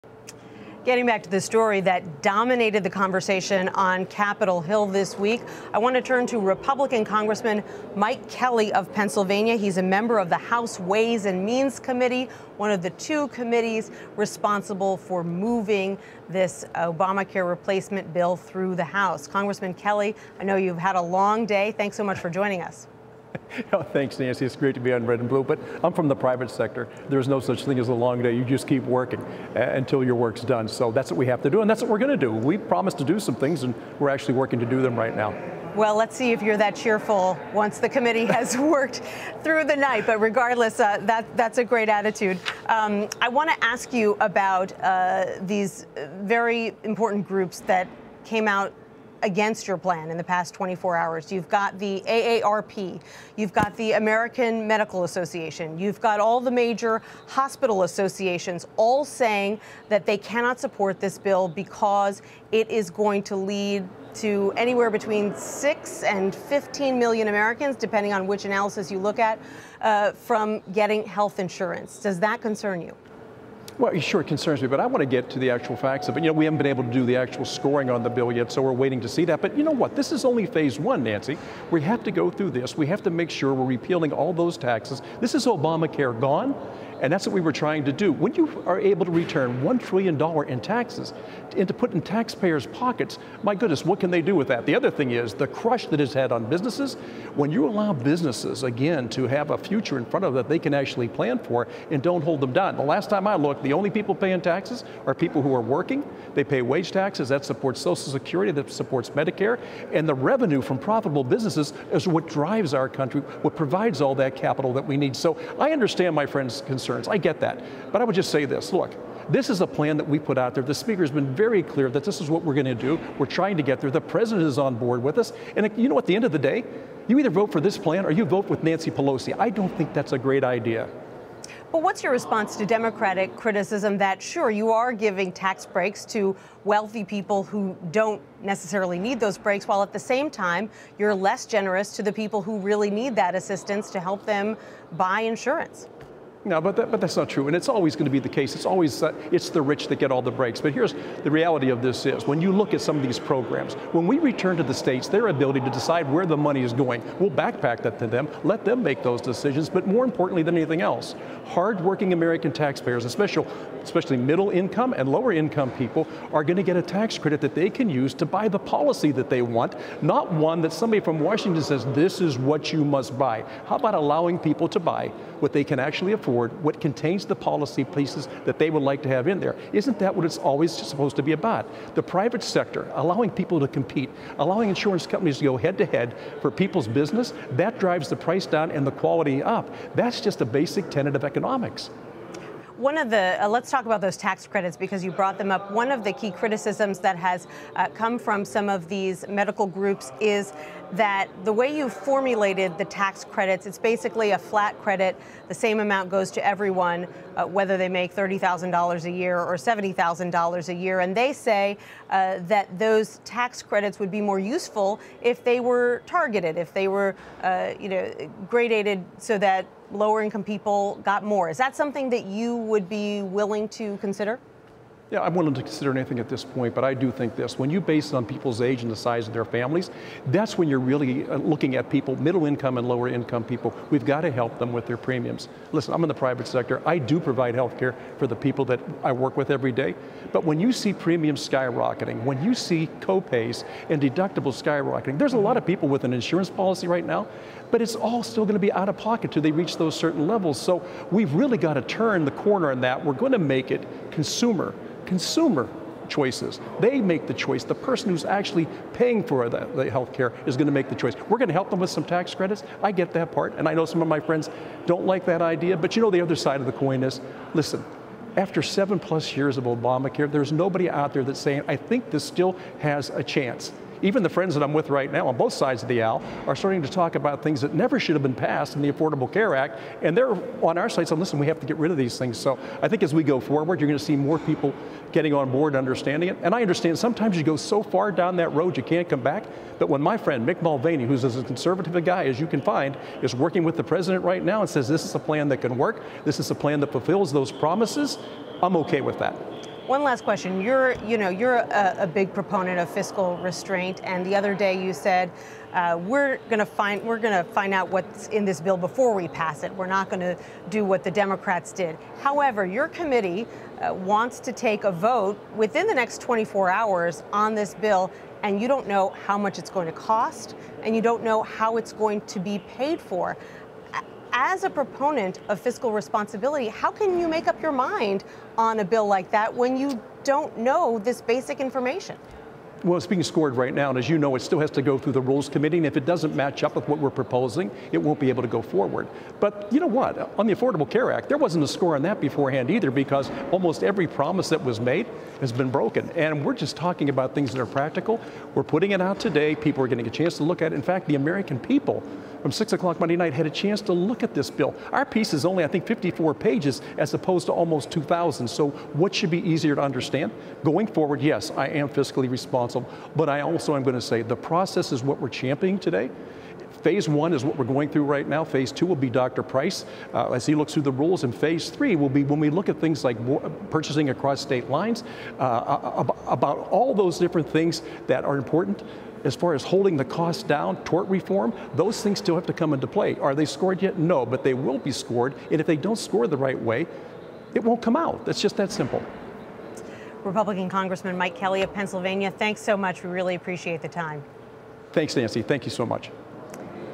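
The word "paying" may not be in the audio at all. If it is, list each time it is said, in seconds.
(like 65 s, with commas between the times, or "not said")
104 s, 258 s.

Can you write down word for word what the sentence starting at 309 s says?
We're not going to do what the Democrats did.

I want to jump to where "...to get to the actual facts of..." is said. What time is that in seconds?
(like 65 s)
74 s.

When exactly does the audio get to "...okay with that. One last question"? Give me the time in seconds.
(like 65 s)
298 s.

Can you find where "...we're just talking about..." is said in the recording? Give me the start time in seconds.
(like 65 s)
346 s.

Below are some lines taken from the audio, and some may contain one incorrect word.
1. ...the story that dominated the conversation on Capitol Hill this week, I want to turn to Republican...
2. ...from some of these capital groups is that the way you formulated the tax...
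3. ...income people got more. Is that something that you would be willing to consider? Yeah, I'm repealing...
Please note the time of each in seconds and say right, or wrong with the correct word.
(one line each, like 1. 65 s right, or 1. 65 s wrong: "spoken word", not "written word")
1. 1 s right
2. 198 s wrong: "medical", not "capital"
3. 220 s wrong: "willing", not "repealing".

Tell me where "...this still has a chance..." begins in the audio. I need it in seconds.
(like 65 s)
272 s.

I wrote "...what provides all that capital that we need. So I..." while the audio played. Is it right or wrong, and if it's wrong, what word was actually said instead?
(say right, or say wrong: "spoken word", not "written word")
right.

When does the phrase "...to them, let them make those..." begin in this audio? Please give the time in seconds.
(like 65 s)
157 s.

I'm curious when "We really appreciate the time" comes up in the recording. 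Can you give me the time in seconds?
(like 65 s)
393 s.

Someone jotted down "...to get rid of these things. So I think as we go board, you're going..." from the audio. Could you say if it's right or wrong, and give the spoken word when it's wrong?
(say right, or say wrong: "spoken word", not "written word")
wrong: "forward", not "board".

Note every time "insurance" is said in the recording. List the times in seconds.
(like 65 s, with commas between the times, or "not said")
71 s, 145 s, 184 s, 246 s.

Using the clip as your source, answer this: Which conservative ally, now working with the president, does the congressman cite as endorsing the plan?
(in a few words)
Mick Mulvaney.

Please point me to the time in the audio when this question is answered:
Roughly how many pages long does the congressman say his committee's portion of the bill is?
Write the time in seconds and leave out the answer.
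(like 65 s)
355 s.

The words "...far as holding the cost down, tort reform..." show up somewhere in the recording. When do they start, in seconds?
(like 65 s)
379 s.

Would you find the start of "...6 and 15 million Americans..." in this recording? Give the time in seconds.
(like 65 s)
65 s.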